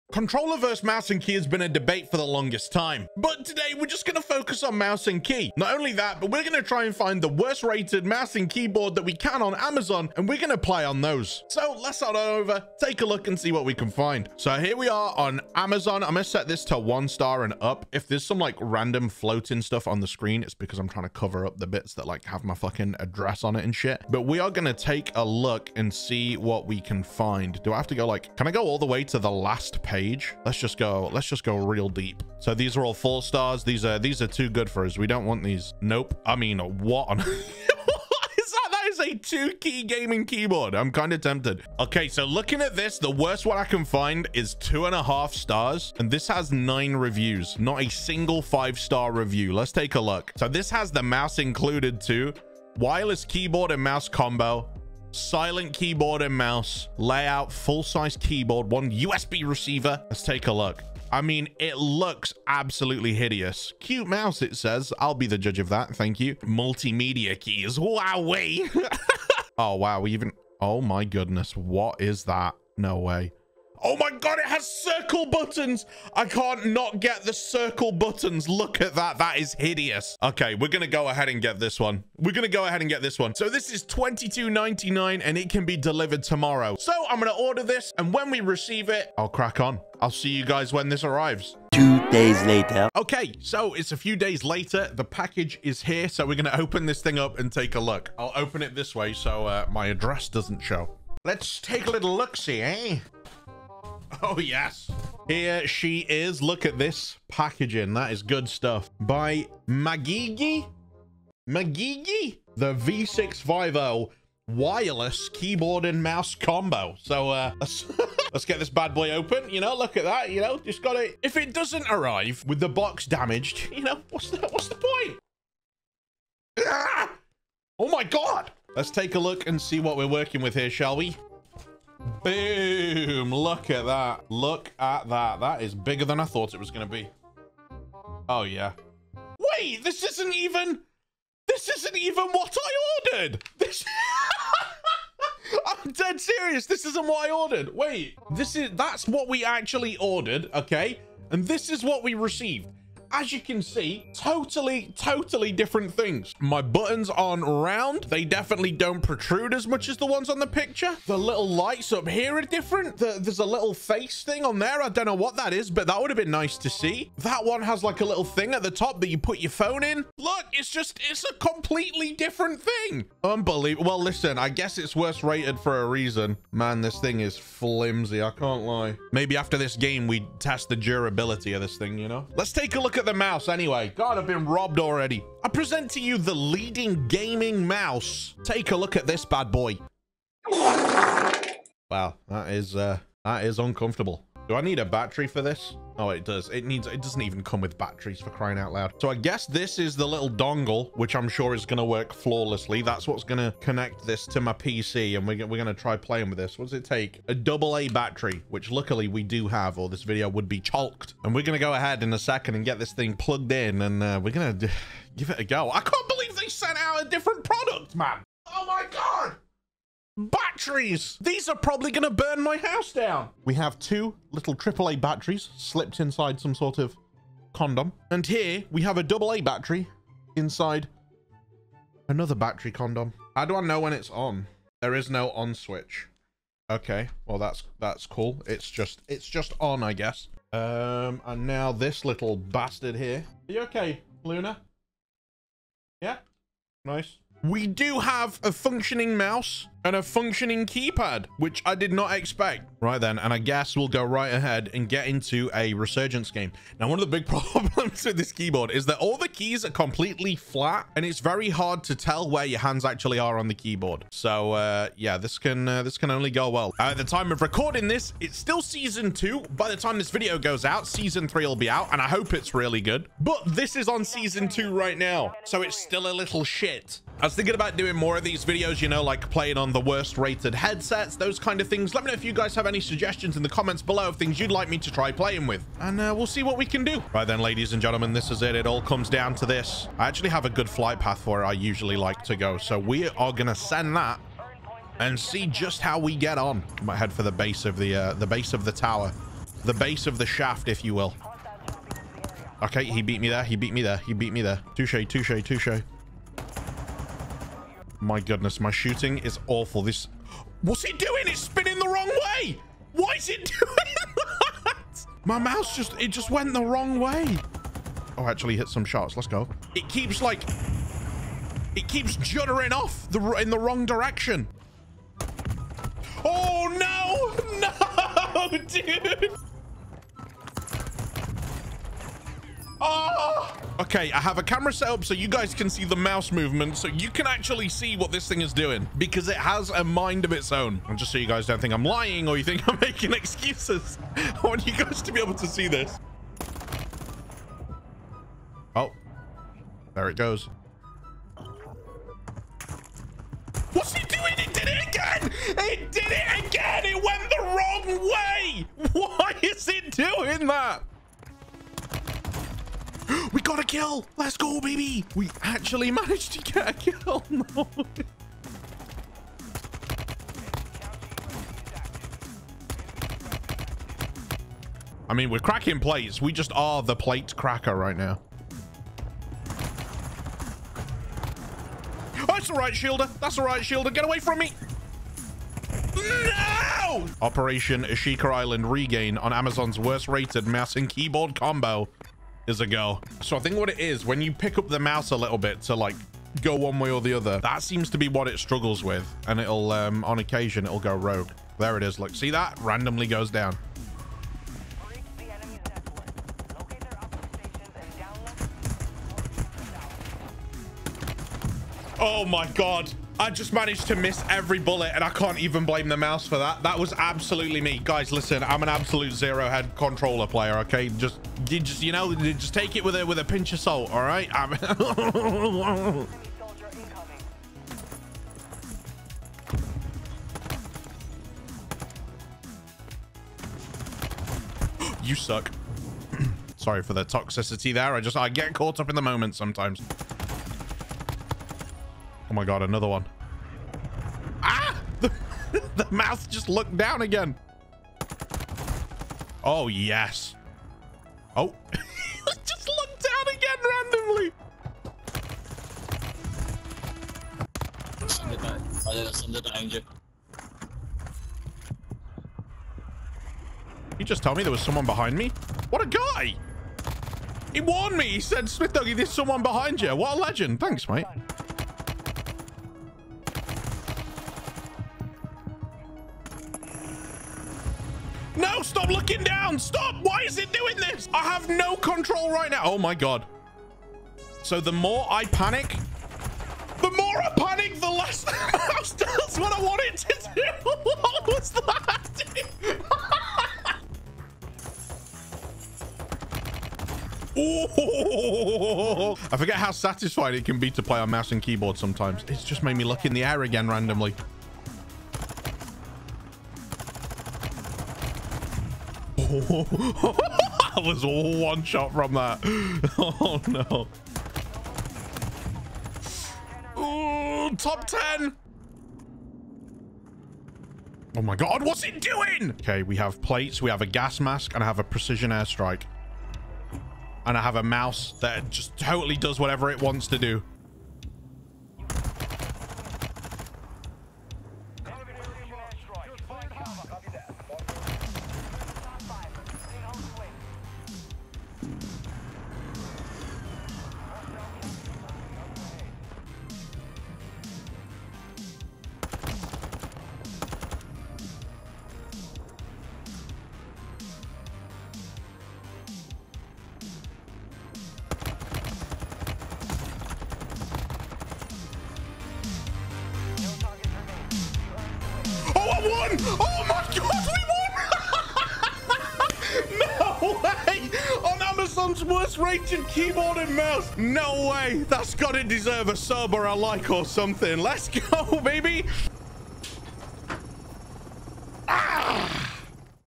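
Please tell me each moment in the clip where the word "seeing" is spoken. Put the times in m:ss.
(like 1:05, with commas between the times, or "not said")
not said.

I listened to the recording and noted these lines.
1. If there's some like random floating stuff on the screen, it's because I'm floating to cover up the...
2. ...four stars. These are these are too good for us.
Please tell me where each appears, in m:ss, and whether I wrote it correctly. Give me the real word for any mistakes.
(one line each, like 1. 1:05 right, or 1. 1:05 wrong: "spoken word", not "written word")
1. 0:17 wrong: "trying", not "floating"
2. 0:32 right.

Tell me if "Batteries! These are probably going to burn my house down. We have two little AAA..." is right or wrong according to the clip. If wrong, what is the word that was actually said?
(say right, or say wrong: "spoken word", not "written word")
right.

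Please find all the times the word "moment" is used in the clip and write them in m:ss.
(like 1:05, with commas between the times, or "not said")
7:19.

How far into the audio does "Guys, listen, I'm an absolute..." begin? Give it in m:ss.
6:57.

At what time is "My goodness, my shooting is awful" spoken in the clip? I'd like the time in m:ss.
5:08.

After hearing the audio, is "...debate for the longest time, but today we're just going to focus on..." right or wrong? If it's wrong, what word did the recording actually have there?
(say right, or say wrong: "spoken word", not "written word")
right.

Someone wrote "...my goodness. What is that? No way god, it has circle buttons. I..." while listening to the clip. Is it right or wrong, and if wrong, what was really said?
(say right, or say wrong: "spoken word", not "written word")
right.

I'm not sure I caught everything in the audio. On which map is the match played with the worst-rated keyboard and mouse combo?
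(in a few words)
Ashika Island.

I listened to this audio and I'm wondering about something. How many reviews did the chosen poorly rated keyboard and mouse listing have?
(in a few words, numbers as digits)
9.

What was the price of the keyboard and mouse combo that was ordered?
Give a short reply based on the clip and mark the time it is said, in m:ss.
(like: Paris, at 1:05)
$22.99, at 1:23.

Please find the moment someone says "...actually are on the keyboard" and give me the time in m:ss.
4:22.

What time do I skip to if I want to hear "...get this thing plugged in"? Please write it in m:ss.
3:32.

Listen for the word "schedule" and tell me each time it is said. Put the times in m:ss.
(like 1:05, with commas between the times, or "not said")
not said.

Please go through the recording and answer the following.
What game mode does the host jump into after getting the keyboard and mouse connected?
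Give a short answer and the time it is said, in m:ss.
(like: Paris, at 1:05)
Resurgence, at 4:15.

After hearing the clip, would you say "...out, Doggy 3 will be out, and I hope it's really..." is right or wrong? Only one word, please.
wrong.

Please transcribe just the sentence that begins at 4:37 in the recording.
I was thinking about doing more of these videos, you know, like playing on the worst rated headsets, those kind of things.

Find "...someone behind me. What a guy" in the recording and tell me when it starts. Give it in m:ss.
7:44.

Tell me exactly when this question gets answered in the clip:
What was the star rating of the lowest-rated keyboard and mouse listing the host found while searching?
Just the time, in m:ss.
0:44.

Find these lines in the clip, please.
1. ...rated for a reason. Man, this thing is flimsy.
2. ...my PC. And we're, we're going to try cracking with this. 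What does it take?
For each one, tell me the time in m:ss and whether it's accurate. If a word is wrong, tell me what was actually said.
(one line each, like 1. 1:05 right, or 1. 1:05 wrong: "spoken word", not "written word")
1. 2:55 right
2. 3:24 wrong: "playing", not "cracking".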